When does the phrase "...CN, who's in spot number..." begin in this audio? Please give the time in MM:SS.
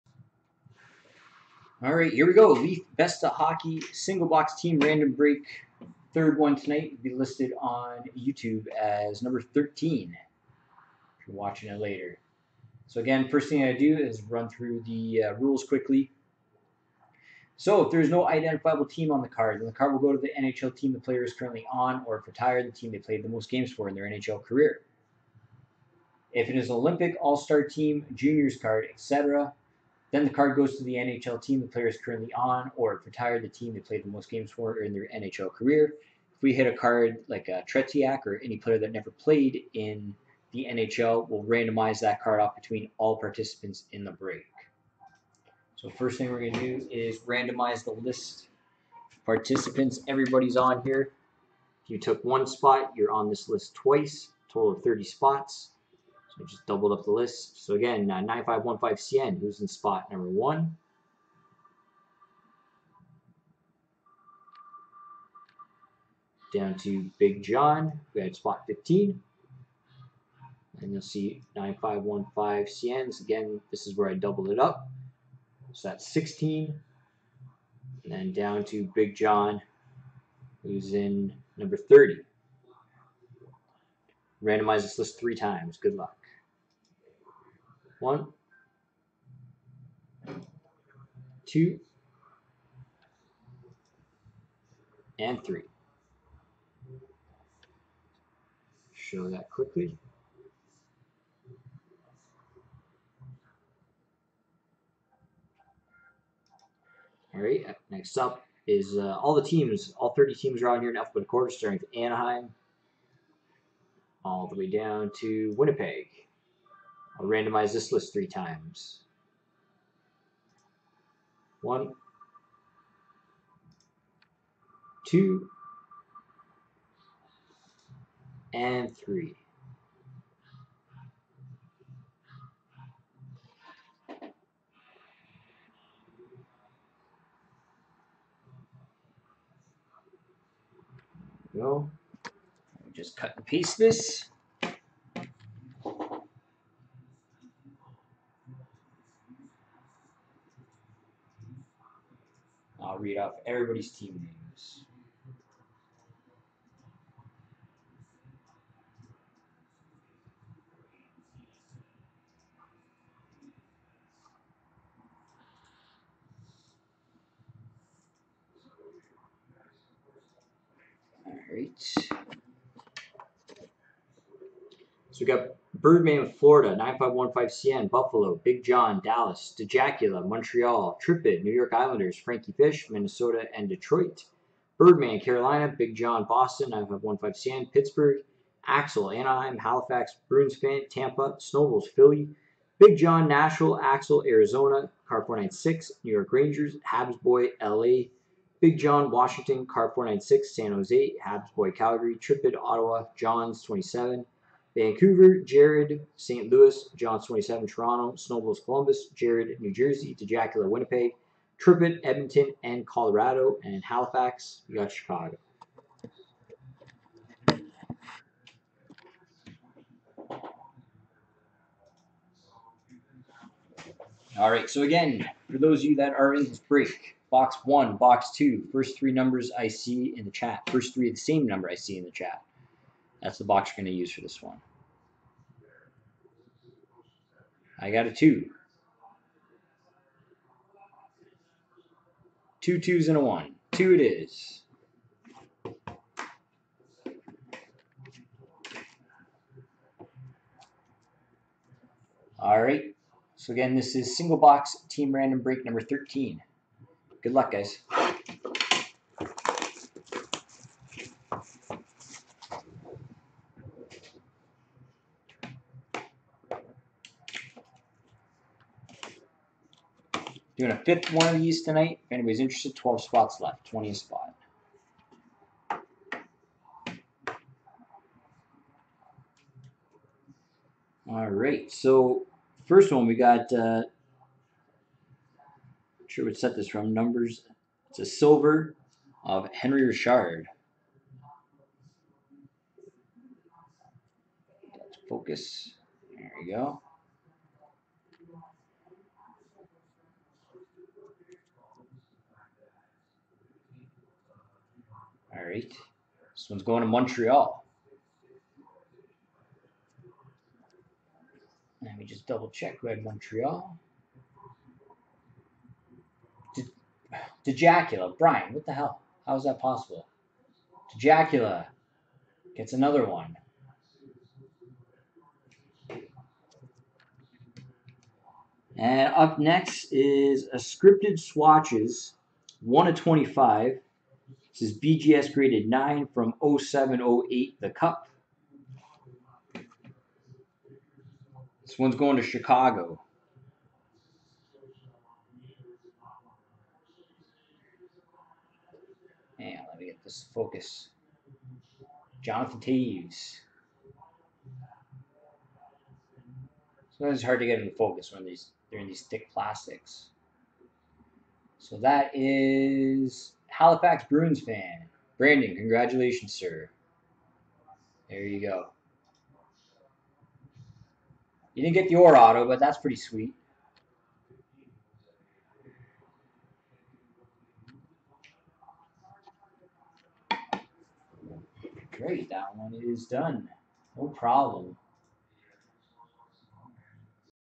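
00:59.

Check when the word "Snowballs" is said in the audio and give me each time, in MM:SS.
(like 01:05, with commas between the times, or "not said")
03:11, 03:28.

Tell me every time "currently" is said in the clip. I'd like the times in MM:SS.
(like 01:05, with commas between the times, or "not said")
00:21, 00:31.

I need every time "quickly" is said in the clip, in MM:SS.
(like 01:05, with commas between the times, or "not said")
00:15, 01:39.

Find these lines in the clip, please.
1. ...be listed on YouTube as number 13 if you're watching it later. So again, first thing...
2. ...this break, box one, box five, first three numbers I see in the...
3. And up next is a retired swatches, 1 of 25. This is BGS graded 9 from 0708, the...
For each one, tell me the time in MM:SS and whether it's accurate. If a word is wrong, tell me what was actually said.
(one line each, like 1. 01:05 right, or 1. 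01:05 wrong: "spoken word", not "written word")
1. 00:07 right
2. 03:46 wrong: "two", not "five"
3. 05:28 wrong: "scripted", not "retired".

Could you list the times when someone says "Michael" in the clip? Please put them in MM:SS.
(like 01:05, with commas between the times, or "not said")
not said.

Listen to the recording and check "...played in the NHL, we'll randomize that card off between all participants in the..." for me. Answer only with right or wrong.
right.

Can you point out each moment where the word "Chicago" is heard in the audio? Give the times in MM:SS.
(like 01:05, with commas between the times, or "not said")
03:34, 05:42.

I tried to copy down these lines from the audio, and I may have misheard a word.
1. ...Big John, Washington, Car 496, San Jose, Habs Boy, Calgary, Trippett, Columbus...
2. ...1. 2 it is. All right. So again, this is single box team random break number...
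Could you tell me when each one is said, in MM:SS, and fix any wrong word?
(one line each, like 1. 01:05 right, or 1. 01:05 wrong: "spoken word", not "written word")
1. 03:18 wrong: "Ottawa", not "Columbus"
2. 04:03 right.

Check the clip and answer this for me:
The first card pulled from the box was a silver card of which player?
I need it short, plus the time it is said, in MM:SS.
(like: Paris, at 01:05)
Henri Richard, at 04:49.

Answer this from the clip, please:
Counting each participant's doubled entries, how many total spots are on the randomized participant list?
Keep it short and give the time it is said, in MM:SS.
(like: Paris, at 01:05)
30, at 00:54.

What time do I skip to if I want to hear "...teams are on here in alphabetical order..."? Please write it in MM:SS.
01:50.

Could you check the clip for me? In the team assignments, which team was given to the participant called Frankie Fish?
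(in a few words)
Minnesota.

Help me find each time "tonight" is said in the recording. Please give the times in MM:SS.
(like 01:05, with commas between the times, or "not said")
00:06, 04:31.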